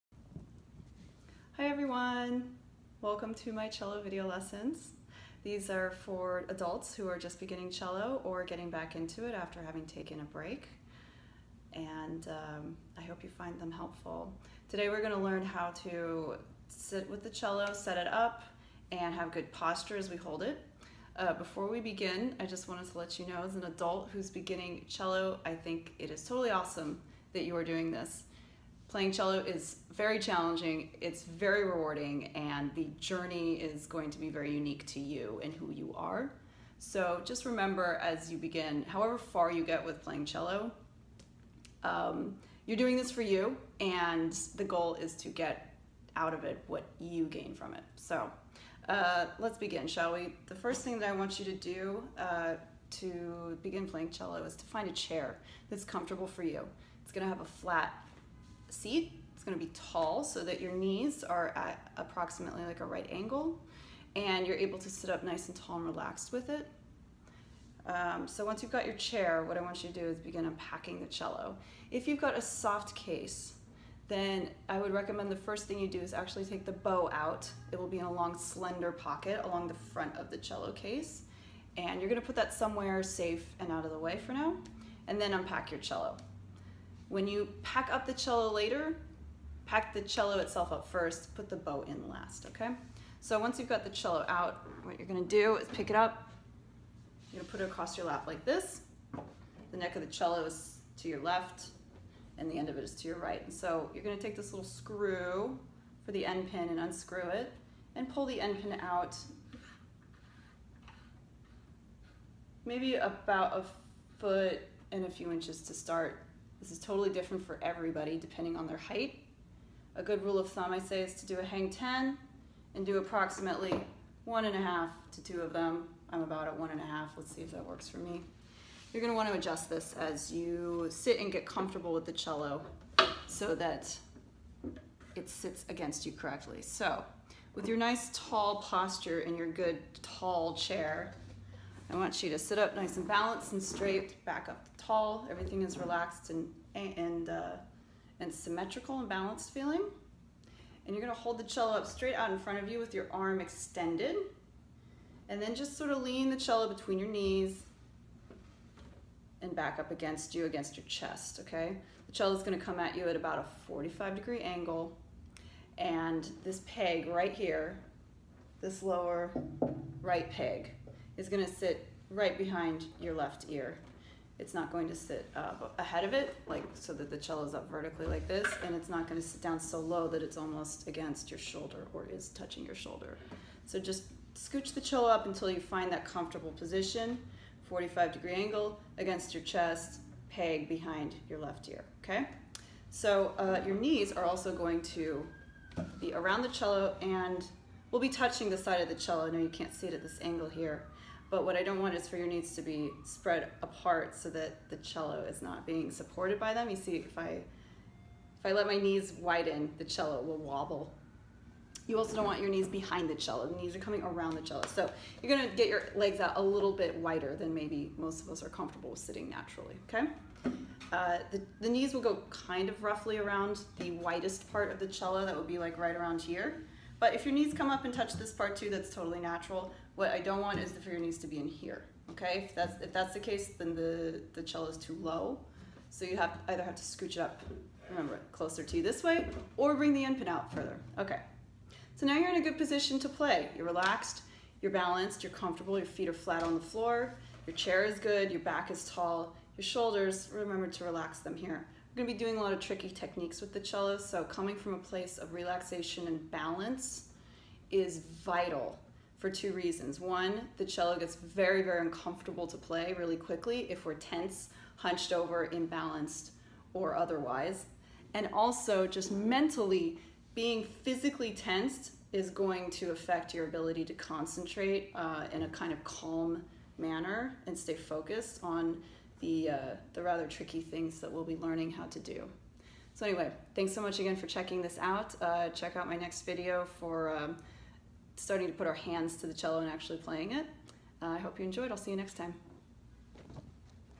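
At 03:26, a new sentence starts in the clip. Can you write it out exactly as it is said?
You see, if I, if I let my knees widen, the cello will wobble.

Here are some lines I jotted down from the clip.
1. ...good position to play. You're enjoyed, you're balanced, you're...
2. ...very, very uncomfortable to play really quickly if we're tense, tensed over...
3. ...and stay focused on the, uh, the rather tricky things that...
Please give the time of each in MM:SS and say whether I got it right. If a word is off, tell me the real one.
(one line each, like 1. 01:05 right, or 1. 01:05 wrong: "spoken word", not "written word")
1. 04:02 wrong: "relaxed", not "enjoyed"
2. 04:21 wrong: "hunched", not "tensed"
3. 04:37 right.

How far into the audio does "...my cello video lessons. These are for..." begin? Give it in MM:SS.
00:03.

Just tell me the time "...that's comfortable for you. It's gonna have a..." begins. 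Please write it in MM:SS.
00:55.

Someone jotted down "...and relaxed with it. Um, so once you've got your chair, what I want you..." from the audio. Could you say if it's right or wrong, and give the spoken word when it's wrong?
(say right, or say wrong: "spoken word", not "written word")
right.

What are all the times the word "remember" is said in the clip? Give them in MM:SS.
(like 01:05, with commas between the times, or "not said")
00:37, 03:57, 04:10.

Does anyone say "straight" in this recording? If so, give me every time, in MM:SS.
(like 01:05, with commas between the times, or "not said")
02:23, 02:31.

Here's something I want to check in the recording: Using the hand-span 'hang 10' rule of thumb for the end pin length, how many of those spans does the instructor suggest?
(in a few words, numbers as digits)
1.5 to 2.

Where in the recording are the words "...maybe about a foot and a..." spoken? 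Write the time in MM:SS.
01:52.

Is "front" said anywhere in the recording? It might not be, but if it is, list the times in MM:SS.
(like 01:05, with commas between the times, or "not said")
01:19, 02:32.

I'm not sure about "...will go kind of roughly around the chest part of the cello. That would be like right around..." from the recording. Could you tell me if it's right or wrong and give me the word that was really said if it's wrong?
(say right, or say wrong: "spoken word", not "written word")
wrong: "widest", not "chest".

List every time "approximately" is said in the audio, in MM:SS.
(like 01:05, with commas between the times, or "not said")
01:01, 02:02.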